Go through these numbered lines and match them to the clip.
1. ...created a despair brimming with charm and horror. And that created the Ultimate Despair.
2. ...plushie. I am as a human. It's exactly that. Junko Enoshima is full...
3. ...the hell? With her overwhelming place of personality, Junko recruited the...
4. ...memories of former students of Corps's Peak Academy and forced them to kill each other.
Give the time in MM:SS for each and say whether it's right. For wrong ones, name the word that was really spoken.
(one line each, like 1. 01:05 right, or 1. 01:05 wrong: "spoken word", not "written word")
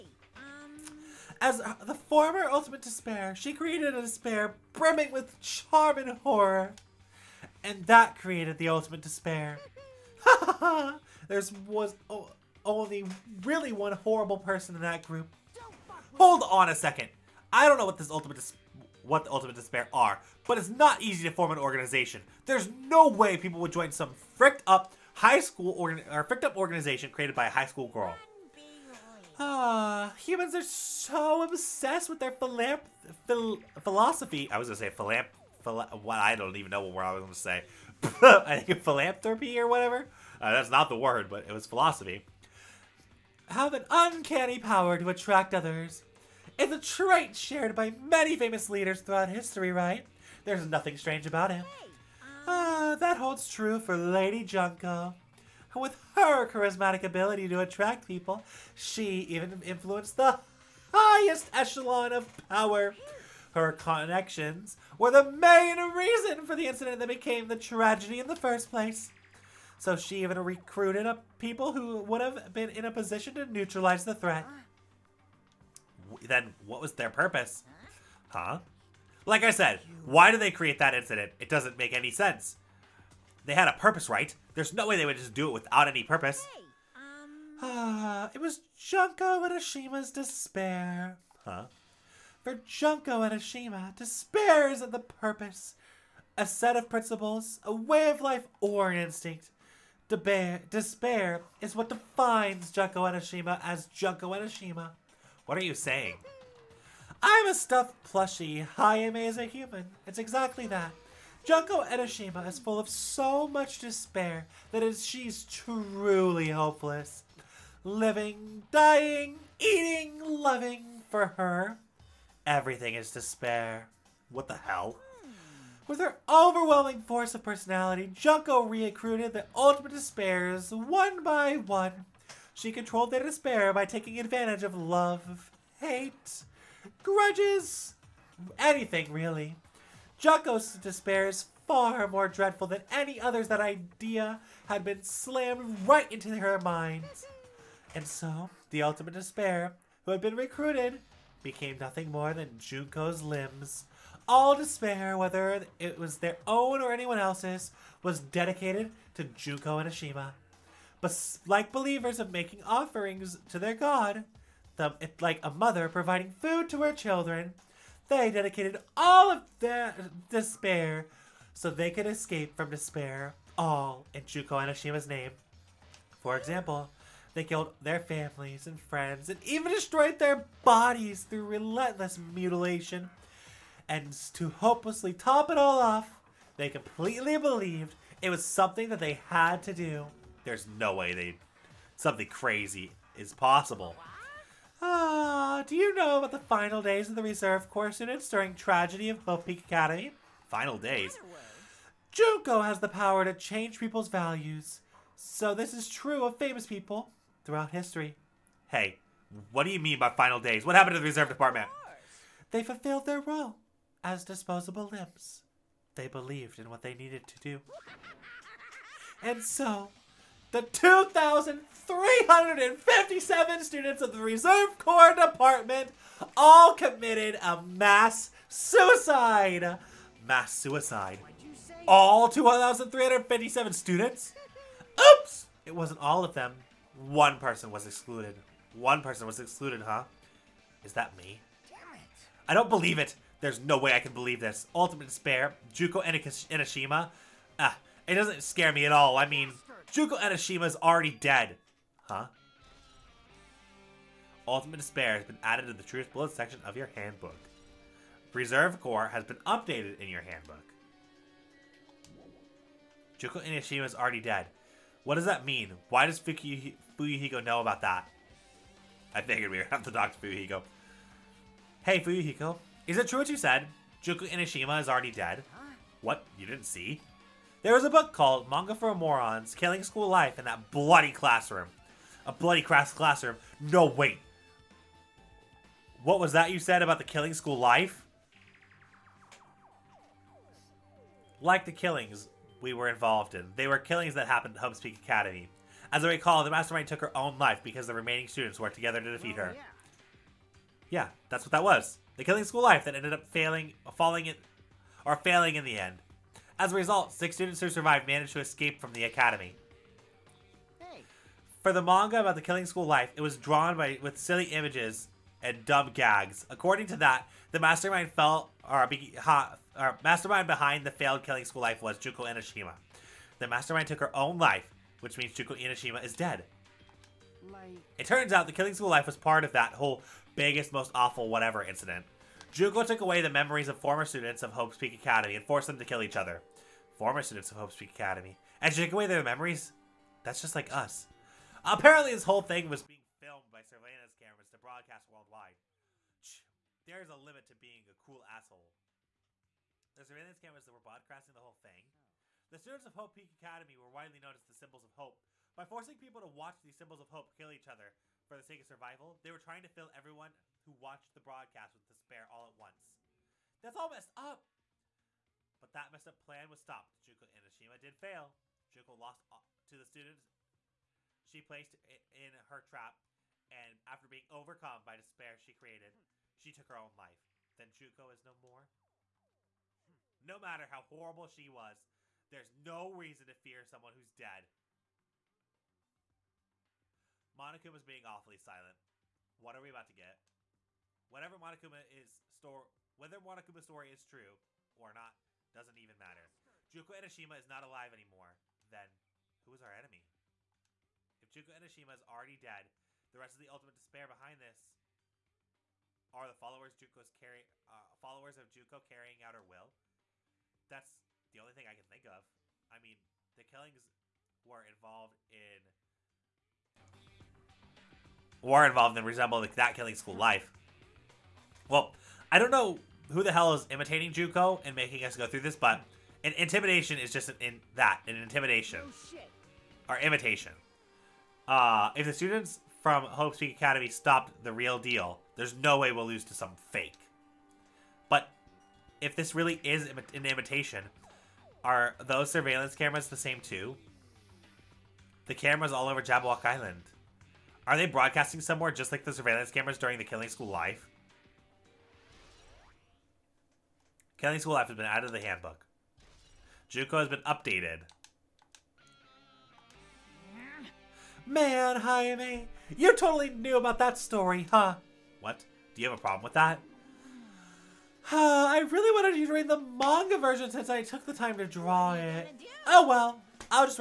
1. 00:03 right
2. 01:48 right
3. 02:04 wrong: "force", not "place"
4. 05:33 wrong: "Hope", not "Corps".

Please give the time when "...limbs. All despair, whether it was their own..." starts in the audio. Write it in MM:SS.
02:33.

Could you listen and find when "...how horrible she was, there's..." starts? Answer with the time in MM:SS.
06:20.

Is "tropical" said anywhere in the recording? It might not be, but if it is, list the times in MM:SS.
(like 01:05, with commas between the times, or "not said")
not said.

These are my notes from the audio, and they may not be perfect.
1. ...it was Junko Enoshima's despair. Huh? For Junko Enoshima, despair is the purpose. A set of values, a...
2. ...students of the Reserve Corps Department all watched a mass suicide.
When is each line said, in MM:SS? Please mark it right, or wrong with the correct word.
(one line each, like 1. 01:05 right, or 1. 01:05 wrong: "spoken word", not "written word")
1. 01:28 wrong: "principles", not "values"
2. 03:43 wrong: "committed", not "watched".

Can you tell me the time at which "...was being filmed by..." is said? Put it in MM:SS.
05:42.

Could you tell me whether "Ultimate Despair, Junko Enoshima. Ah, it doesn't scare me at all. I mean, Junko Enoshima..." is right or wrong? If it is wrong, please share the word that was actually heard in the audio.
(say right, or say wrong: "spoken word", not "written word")
right.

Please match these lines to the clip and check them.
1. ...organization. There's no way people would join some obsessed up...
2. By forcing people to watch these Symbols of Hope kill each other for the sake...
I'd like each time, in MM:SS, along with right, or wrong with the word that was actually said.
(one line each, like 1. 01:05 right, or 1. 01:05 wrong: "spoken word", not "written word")
1. 00:21 wrong: "fricked", not "obsessed"
2. 05:55 right.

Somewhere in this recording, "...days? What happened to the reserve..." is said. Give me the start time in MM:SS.
03:30.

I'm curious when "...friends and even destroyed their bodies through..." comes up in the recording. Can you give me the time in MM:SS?
02:58.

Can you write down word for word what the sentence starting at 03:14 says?
Ah, Ah, uh, do you know about the final days of the reserve corps units during tragedy of Hope Peak Academy?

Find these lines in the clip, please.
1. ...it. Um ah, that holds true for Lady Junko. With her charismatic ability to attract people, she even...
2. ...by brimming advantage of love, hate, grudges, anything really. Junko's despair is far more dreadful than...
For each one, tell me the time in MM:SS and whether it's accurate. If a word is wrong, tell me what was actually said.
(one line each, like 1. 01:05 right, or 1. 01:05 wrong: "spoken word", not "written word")
1. 00:51 right
2. 02:13 wrong: "taking", not "brimming".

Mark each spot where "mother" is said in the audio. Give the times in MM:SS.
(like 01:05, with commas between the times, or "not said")
02:45.